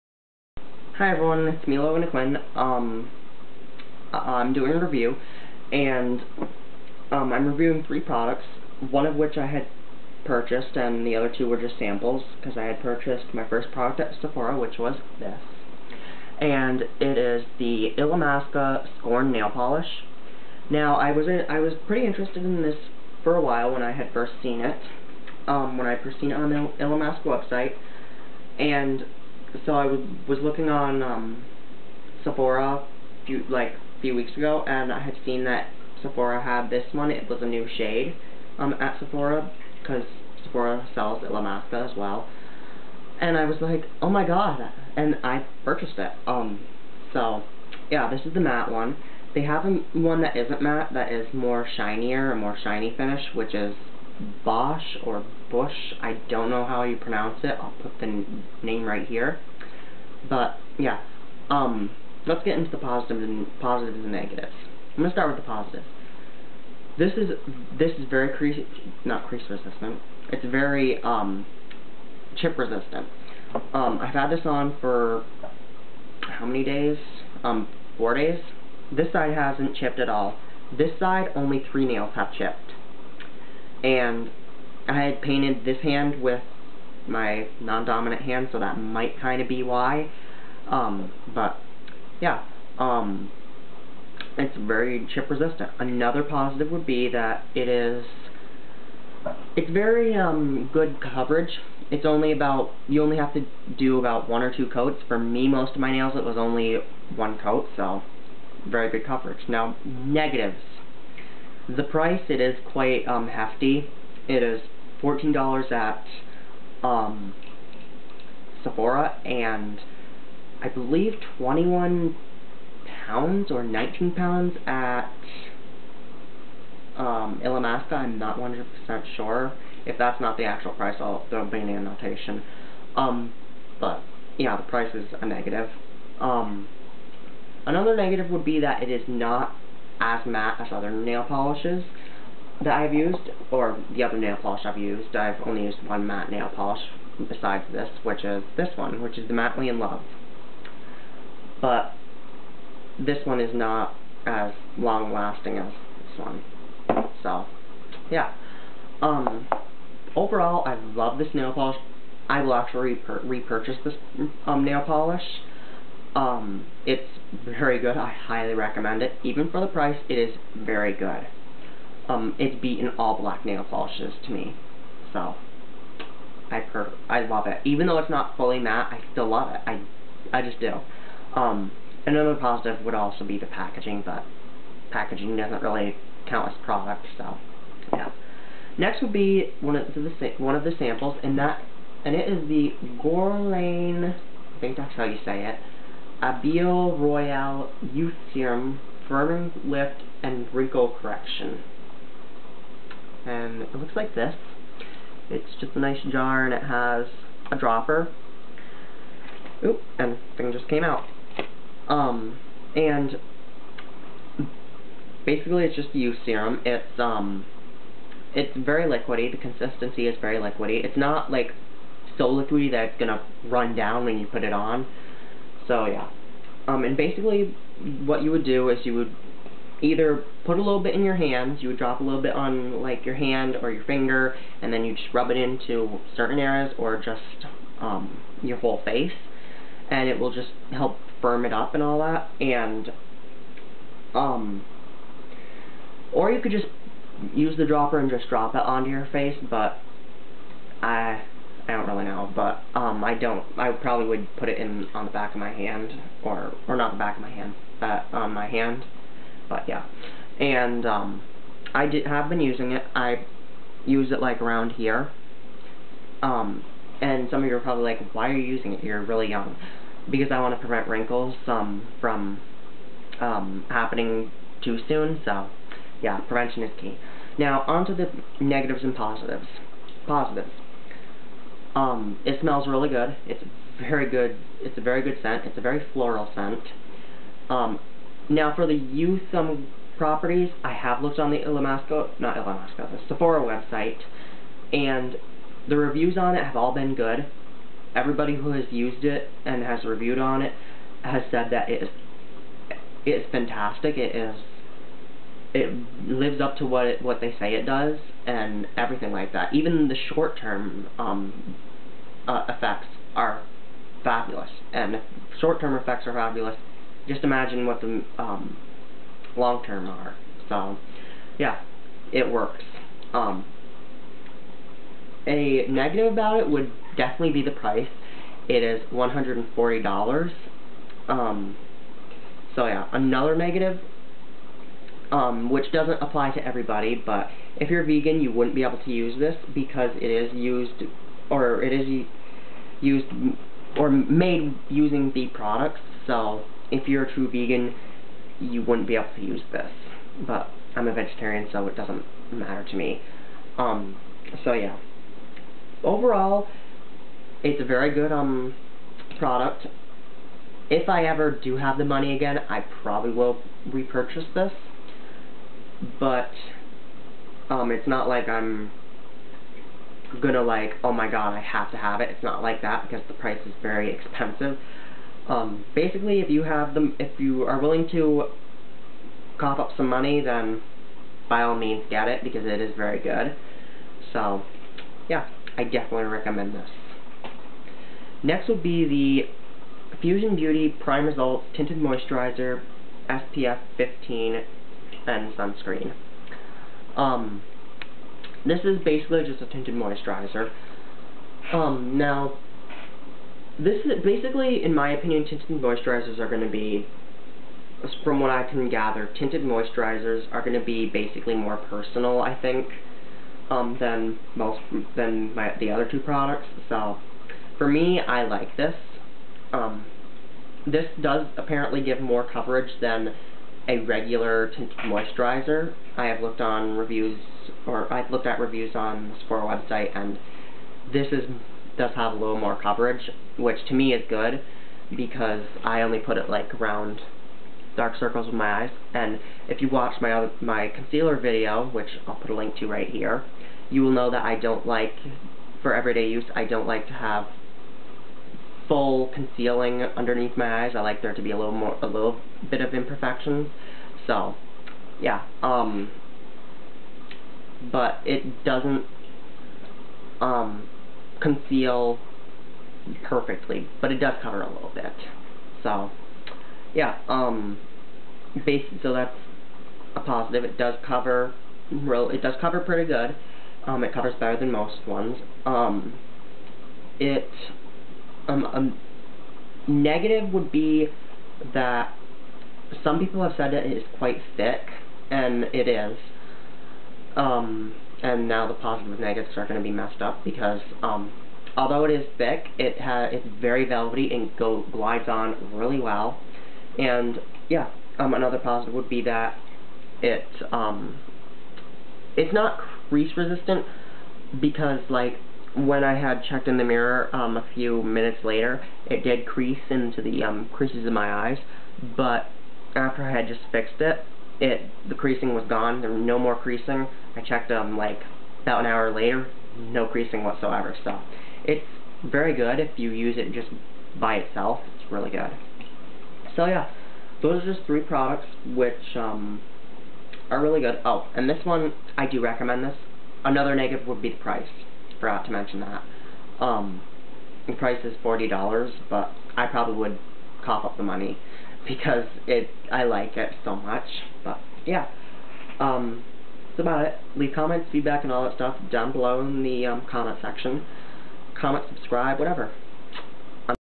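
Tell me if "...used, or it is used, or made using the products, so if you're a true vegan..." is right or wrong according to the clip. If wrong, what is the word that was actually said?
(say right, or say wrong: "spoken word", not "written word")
right.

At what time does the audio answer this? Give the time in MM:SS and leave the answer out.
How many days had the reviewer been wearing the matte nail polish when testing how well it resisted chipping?
01:17.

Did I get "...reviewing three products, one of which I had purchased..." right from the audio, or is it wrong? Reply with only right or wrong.
right.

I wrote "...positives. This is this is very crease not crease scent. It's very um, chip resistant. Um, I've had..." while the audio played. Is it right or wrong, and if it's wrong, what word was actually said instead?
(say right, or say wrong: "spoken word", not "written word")
wrong: "resistant", not "scent".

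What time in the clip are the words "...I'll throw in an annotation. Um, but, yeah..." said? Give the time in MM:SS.
02:10.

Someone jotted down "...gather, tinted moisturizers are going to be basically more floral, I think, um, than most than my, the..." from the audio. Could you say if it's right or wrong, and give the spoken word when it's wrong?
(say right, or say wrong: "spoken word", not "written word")
wrong: "personal", not "floral".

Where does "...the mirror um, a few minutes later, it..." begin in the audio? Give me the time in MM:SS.
08:26.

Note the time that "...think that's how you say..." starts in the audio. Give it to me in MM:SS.
03:14.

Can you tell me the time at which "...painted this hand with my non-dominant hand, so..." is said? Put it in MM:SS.
01:25.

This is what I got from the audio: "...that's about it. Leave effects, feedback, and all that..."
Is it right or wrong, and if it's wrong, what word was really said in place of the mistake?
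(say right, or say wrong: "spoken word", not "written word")
wrong: "comments", not "effects".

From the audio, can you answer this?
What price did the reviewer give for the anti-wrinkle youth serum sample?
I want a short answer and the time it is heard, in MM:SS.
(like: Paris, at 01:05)
$140, at 05:28.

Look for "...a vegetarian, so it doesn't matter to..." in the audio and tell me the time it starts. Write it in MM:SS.
05:50.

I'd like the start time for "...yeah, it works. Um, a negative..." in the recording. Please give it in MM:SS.
05:21.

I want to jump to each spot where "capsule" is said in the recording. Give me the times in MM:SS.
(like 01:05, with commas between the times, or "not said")
not said.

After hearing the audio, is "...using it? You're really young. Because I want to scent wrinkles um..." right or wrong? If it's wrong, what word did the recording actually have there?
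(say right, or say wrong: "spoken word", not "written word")
wrong: "prevent", not "scent".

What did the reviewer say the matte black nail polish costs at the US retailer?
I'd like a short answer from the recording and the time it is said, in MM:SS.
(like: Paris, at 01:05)
$14, at 01:55.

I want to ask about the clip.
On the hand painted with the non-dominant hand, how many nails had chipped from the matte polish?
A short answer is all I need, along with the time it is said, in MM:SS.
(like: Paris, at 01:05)
3, at 01:21.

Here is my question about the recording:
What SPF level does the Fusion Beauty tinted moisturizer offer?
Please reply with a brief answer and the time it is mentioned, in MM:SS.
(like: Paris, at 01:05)
SPF 15, at 06:33.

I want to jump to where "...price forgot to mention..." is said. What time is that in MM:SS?
08:54.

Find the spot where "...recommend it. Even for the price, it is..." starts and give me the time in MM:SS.
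02:48.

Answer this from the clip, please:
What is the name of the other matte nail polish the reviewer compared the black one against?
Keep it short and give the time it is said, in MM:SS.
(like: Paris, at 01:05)
Matte We In Love, at 02:29.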